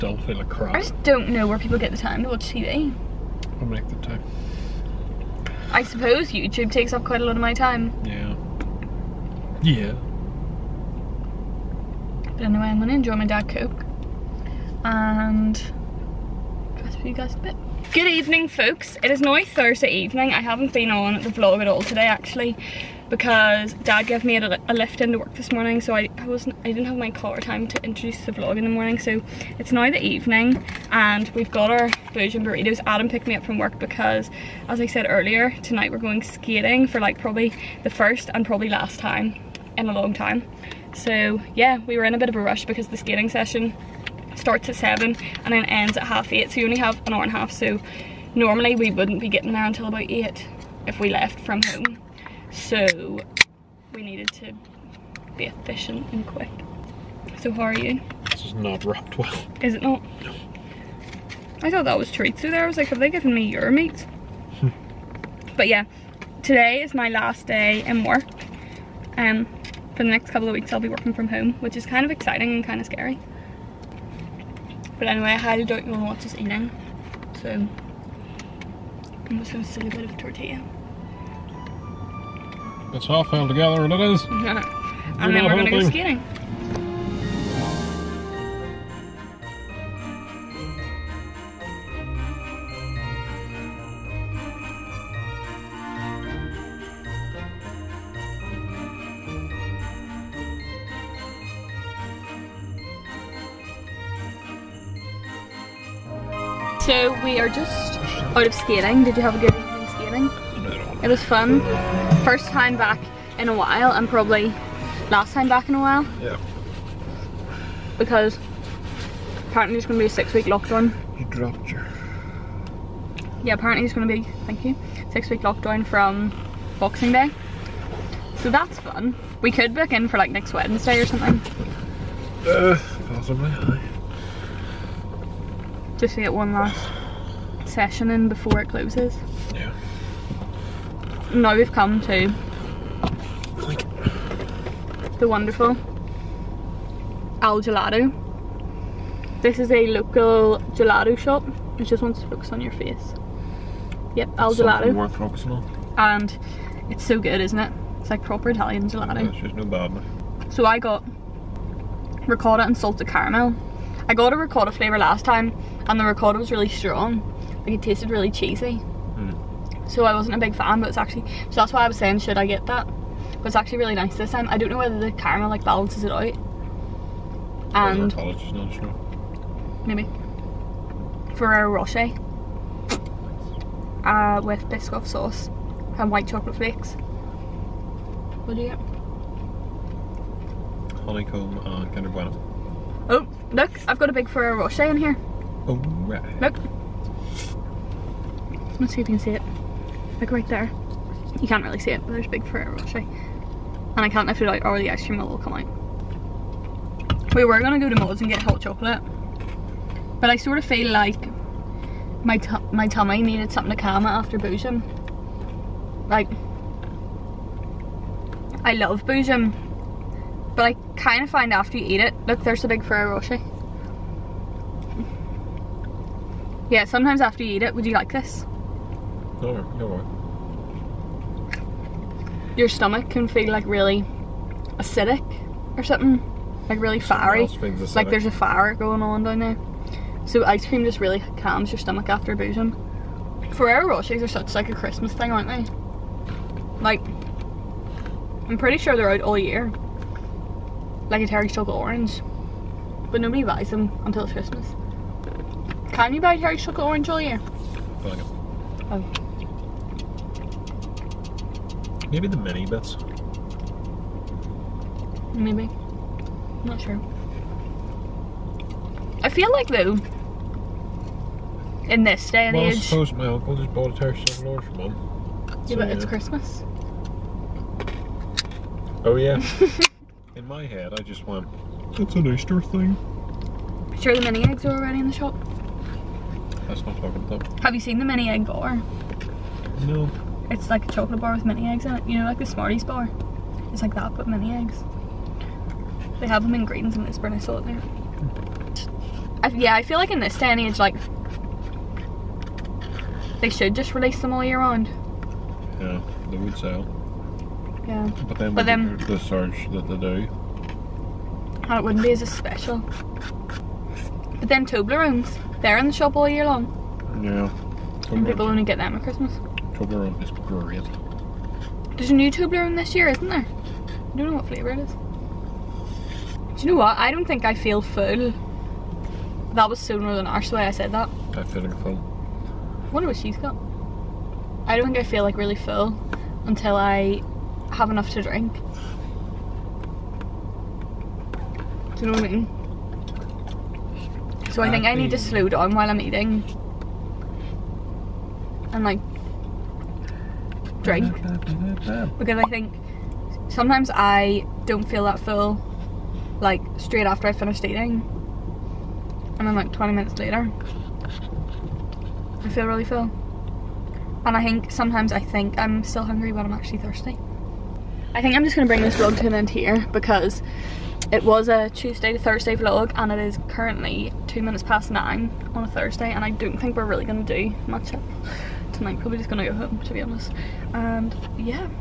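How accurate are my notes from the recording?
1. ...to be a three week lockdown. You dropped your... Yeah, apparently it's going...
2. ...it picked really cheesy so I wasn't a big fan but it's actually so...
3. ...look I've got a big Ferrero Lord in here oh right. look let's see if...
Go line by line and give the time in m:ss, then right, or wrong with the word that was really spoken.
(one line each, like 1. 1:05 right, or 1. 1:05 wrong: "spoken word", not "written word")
1. 1:59 wrong: "six", not "three"
2. 2:47 wrong: "tasted", not "picked"
3. 3:13 wrong: "Rocher", not "Lord".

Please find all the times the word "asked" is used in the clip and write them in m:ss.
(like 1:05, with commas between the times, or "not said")
not said.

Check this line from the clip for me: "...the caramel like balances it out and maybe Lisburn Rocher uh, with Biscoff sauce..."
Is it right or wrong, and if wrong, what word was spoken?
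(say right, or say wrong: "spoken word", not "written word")
wrong: "Ferrero", not "Lisburn".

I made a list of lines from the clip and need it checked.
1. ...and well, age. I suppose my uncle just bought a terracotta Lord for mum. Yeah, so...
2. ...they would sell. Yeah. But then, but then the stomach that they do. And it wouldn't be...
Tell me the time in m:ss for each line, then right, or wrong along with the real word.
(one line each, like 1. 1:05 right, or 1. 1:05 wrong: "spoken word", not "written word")
1. 4:32 right
2. 5:06 wrong: "search", not "stomach".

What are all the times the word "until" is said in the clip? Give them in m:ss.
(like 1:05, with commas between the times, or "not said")
0:49, 4:14, 5:36.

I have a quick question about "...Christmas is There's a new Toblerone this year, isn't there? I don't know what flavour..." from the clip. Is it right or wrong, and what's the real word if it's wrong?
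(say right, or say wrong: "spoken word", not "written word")
right.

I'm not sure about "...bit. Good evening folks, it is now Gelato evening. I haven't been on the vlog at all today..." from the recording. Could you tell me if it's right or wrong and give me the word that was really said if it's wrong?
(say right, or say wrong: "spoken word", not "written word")
wrong: "Thursday", not "Gelato".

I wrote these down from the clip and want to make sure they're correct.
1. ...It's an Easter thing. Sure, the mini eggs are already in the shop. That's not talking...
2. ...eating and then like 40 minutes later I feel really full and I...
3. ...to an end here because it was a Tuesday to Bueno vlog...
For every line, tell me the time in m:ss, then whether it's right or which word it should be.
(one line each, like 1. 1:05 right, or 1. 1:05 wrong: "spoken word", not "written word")
1. 4:41 right
2. 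5:57 wrong: "20", not "40"
3. 6:09 wrong: "Thursday", not "Bueno".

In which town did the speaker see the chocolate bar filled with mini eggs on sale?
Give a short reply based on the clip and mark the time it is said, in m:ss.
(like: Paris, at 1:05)
Lisburn, at 4:57.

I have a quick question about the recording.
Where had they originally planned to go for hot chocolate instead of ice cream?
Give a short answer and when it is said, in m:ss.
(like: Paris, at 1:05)
Moles, at 3:27.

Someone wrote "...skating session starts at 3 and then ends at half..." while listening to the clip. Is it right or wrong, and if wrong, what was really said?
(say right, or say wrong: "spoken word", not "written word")
wrong: "7", not "3".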